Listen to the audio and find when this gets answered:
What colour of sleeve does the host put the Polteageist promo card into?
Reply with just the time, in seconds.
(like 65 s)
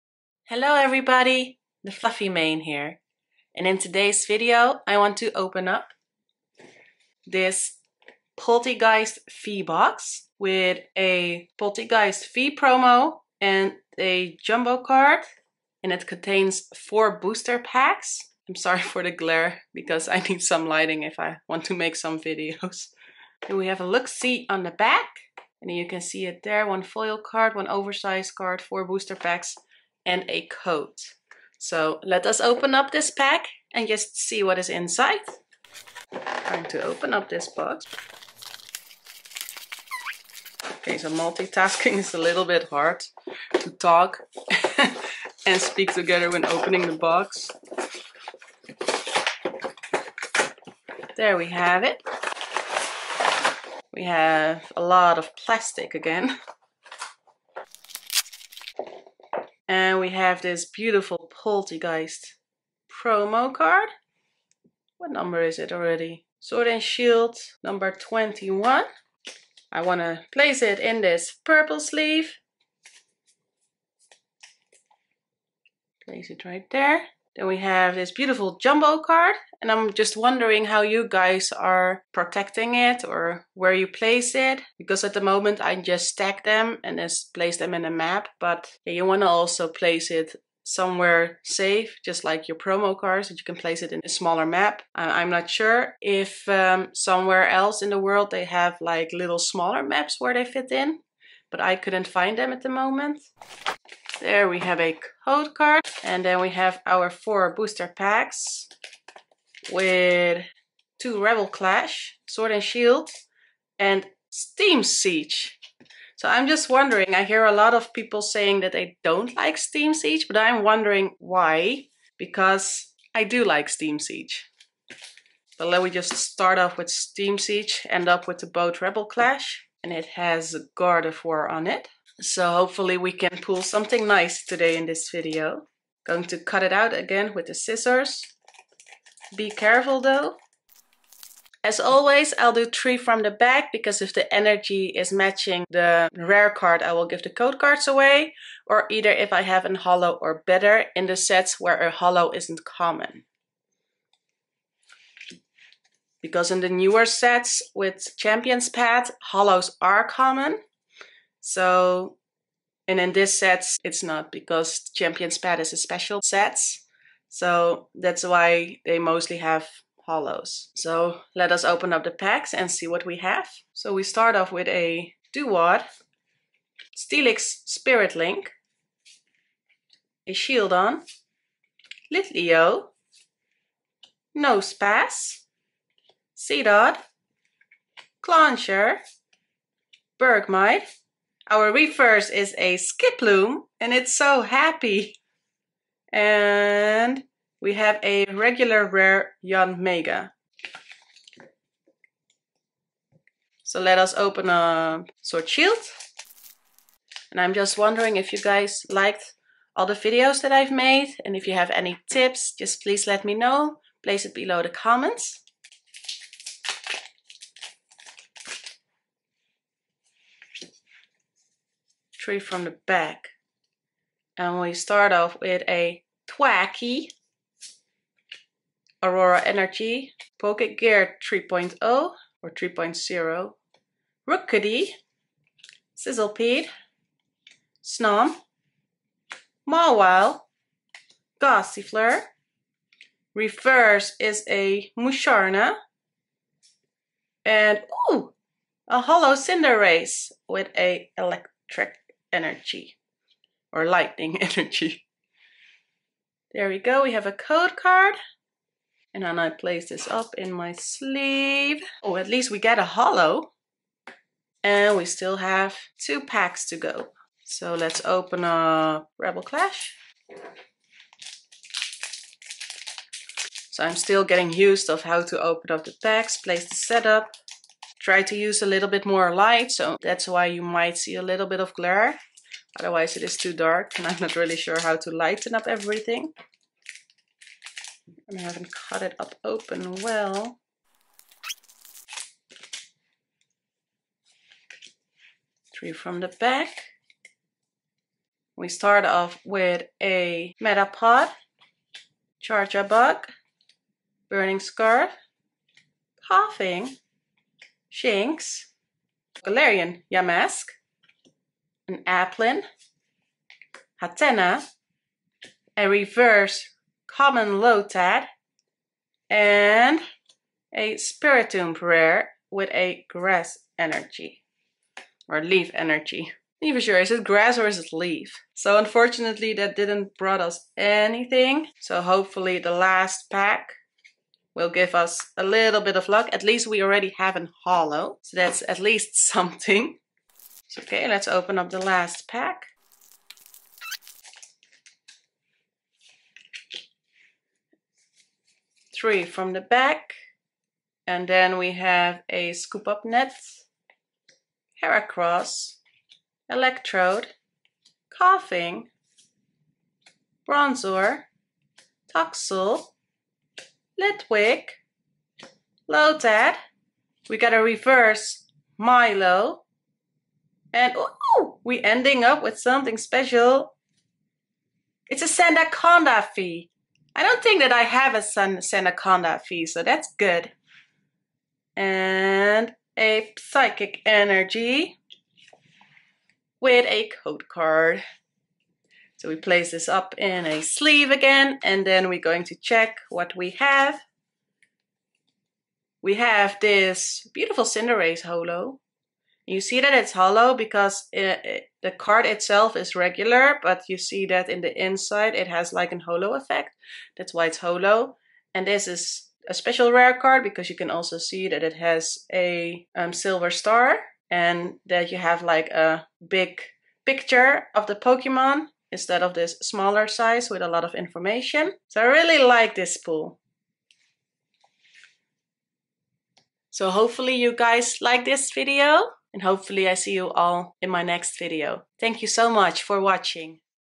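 71 s.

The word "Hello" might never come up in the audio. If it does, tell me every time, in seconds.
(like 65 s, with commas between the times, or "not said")
0 s, 365 s.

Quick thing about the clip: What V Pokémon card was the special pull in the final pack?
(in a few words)
Sandaconda V.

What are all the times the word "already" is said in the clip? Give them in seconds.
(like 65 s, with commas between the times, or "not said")
65 s, 336 s.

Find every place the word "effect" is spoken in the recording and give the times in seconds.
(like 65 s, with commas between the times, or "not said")
406 s.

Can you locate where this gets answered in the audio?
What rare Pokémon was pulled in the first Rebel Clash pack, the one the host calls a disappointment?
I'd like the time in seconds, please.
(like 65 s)
320 s.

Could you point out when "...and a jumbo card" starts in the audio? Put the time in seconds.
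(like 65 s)
13 s.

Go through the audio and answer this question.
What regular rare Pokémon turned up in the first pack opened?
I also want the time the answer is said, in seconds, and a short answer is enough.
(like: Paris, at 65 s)
Yanmega, at 199 s.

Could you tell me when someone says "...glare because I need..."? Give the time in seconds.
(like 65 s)
19 s.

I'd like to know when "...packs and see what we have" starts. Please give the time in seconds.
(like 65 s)
172 s.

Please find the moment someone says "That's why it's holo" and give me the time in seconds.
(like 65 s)
407 s.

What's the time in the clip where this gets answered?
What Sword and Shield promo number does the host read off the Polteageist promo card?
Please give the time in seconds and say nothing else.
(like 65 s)
67 s.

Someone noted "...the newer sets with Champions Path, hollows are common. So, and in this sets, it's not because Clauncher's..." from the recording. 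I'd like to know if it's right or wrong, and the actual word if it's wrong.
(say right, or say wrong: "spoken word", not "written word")
wrong: "Champion", not "Clauncher".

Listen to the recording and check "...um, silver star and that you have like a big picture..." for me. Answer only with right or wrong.
right.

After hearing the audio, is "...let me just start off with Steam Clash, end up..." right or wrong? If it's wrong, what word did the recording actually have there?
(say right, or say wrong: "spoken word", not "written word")
wrong: "Siege", not "Clash".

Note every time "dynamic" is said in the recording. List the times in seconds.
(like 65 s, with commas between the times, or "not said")
not said.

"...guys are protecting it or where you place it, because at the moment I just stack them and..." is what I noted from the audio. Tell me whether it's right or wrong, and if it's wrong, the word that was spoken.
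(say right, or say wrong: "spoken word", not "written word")
right.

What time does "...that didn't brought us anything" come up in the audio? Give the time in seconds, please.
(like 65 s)
329 s.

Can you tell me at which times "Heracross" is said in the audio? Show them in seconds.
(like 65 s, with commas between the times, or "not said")
354 s.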